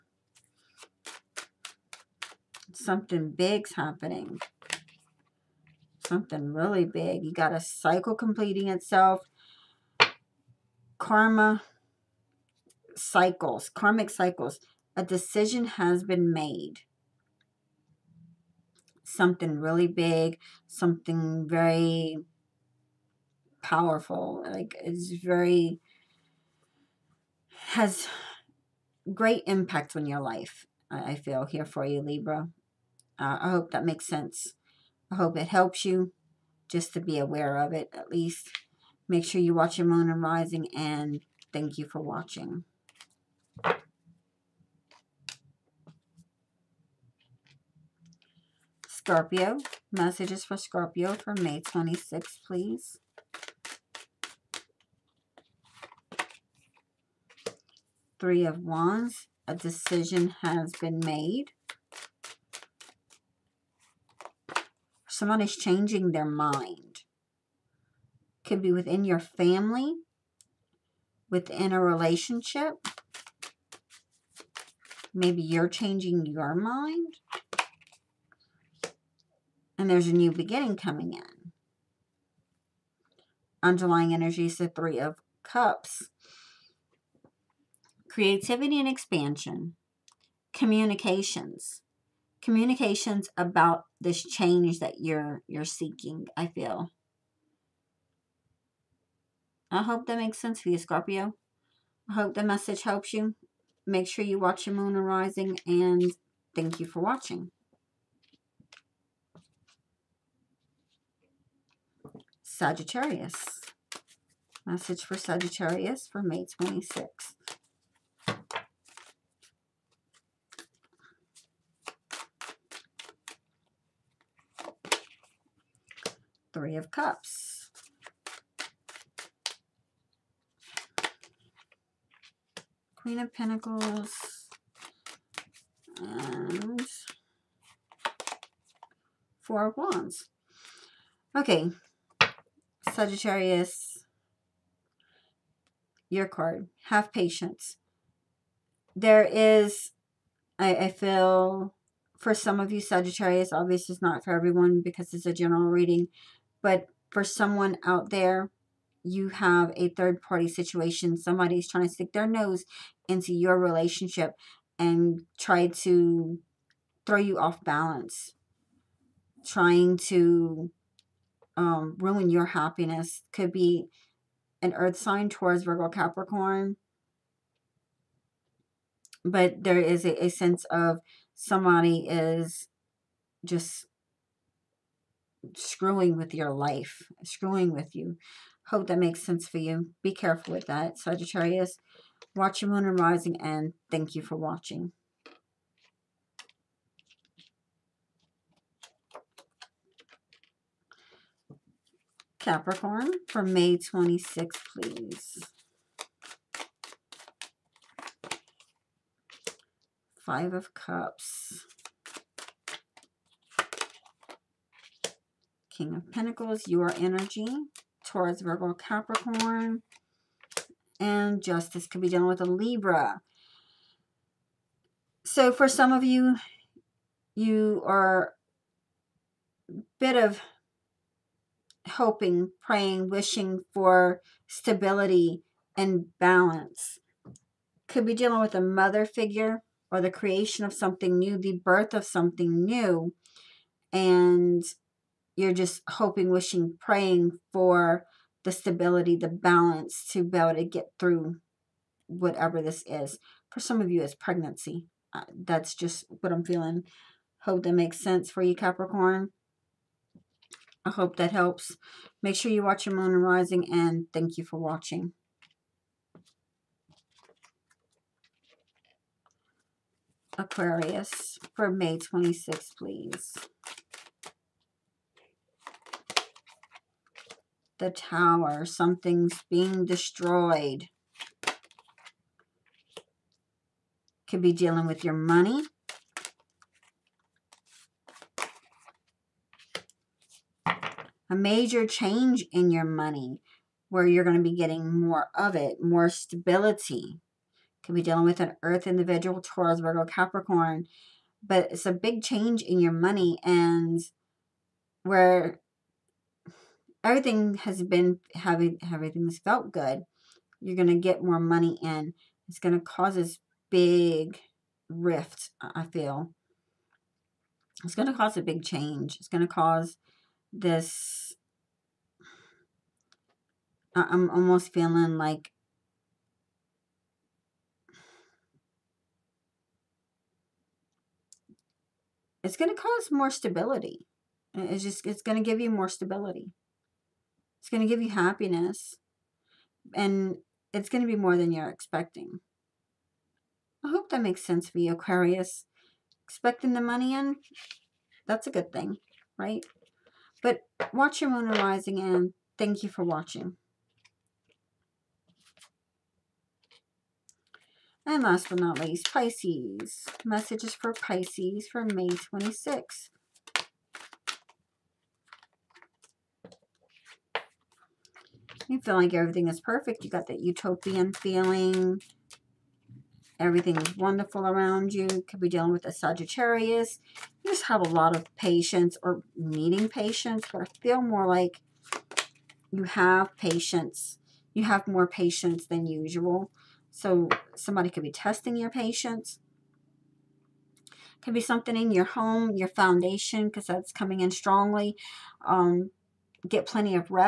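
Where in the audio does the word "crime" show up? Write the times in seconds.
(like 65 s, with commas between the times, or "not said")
not said.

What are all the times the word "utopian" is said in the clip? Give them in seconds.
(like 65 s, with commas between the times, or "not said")
370 s.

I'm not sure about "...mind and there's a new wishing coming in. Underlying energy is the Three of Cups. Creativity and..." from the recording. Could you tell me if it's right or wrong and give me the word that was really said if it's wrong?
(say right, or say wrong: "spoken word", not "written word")
wrong: "beginning", not "wishing".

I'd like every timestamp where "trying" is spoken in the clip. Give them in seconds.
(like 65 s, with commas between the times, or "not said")
161 s, 169 s.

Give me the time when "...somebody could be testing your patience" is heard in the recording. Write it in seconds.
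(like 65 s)
387 s.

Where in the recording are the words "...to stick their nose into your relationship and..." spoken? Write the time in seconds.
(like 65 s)
161 s.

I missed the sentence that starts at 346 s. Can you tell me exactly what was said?
Expecting the money in, that's a good thing, right?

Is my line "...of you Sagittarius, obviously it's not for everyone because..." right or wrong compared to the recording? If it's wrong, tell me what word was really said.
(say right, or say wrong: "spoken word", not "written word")
right.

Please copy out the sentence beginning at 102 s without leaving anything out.
I hope the message helps you.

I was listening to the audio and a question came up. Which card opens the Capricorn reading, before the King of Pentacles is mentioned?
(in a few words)
Five of Cups.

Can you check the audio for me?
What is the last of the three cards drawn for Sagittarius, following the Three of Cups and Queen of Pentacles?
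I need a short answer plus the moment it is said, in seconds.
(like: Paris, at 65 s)
Four of Wands, at 139 s.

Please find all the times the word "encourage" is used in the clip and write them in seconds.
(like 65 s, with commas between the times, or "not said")
not said.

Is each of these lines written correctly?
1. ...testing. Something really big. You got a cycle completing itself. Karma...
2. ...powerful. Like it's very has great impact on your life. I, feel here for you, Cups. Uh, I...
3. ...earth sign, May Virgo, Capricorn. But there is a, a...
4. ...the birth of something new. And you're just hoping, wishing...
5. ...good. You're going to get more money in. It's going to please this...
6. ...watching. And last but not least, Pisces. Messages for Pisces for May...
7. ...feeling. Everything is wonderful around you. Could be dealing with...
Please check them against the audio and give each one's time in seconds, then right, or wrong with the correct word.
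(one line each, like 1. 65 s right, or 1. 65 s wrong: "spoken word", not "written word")
1. 3 s wrong: "happening", not "testing"
2. 23 s wrong: "Libra", not "Cups"
3. 174 s wrong: "Taurus", not "May"
4. 241 s right
5. 309 s wrong: "cause", not "please"
6. 353 s right
7. 371 s right.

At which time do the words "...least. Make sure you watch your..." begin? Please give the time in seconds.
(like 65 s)
38 s.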